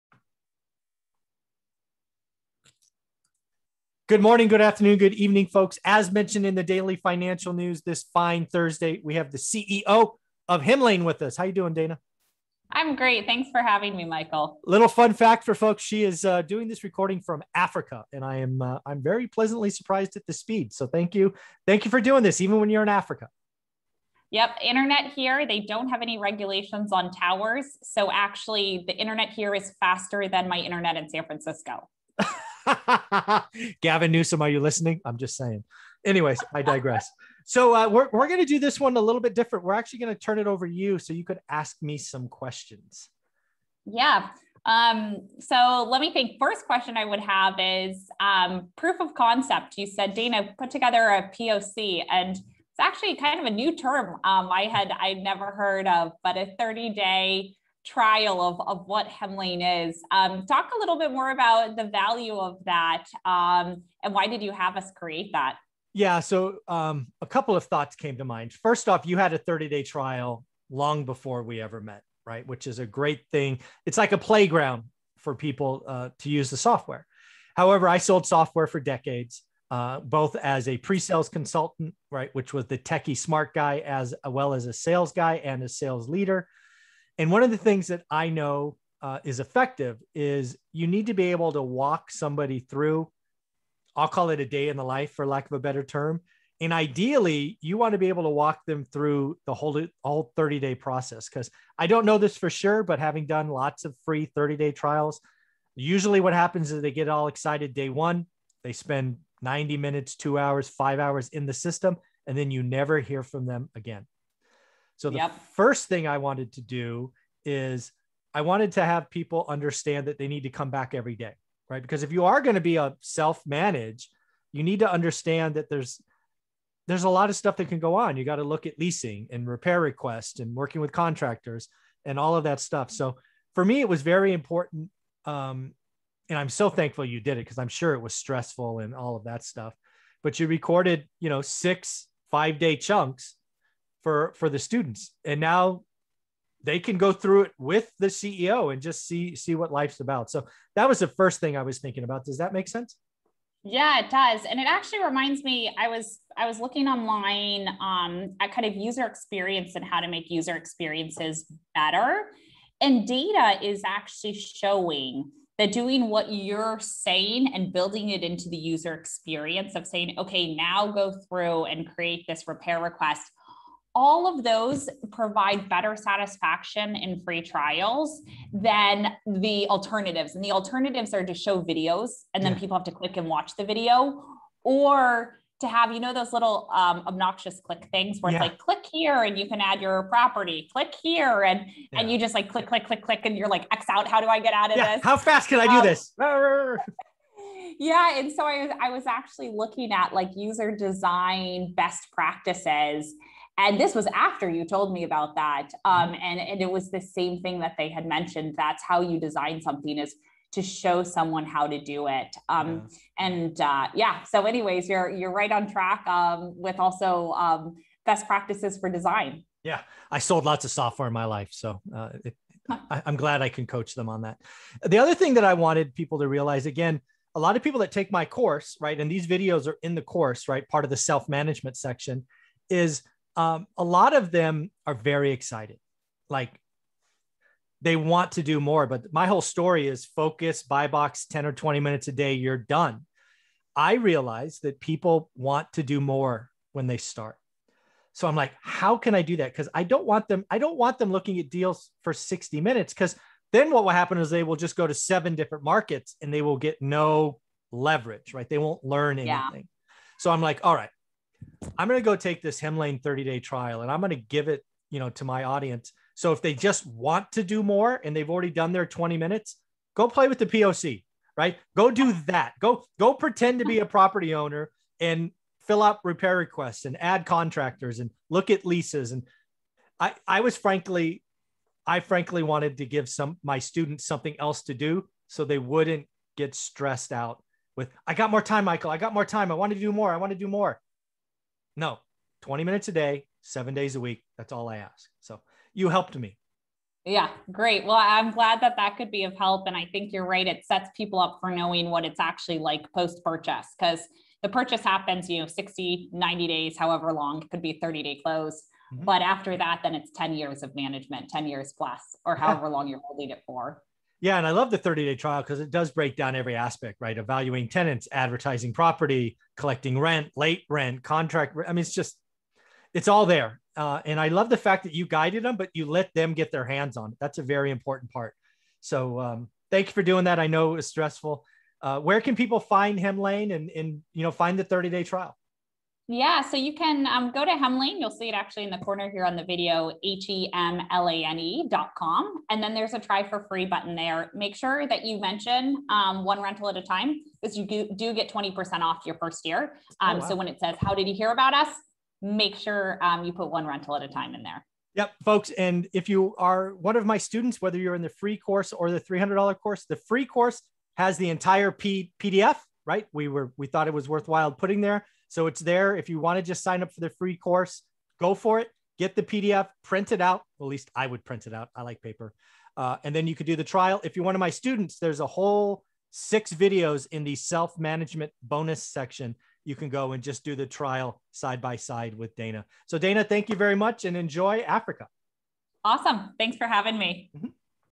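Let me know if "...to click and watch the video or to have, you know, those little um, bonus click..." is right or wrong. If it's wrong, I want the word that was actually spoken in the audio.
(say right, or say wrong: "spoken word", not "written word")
wrong: "obnoxious", not "bonus".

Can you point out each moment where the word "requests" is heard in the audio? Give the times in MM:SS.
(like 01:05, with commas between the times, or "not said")
02:09, 02:52, 04:36.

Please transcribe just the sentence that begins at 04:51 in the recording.
No, 20 minutes a day, seven days a week.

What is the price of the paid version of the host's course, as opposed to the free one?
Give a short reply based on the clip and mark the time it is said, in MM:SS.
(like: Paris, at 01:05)
$300, at 05:58.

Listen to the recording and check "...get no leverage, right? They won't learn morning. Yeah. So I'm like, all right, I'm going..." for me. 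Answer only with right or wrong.
wrong.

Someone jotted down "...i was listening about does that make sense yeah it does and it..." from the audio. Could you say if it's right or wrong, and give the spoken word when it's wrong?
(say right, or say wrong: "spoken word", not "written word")
wrong: "thinking", not "listening".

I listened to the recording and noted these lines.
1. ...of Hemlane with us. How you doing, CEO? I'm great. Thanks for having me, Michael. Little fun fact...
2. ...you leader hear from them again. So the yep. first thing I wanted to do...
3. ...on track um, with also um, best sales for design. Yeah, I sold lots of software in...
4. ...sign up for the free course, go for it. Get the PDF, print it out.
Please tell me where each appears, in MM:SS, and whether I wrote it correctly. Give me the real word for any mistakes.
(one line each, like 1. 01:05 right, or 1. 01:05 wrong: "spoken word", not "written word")
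1. 00:10 wrong: "Dana", not "CEO"
2. 01:52 wrong: "never", not "leader"
3. 03:35 wrong: "practices", not "sales"
4. 06:06 right.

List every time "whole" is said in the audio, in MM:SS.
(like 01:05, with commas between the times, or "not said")
01:39, 03:59, 06:15.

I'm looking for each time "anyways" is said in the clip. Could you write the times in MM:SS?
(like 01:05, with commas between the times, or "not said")
00:36, 03:34.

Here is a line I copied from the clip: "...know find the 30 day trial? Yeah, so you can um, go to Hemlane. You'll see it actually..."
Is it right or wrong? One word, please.
right.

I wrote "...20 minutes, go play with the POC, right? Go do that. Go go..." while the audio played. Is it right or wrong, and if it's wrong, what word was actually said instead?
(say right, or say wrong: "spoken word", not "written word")
right.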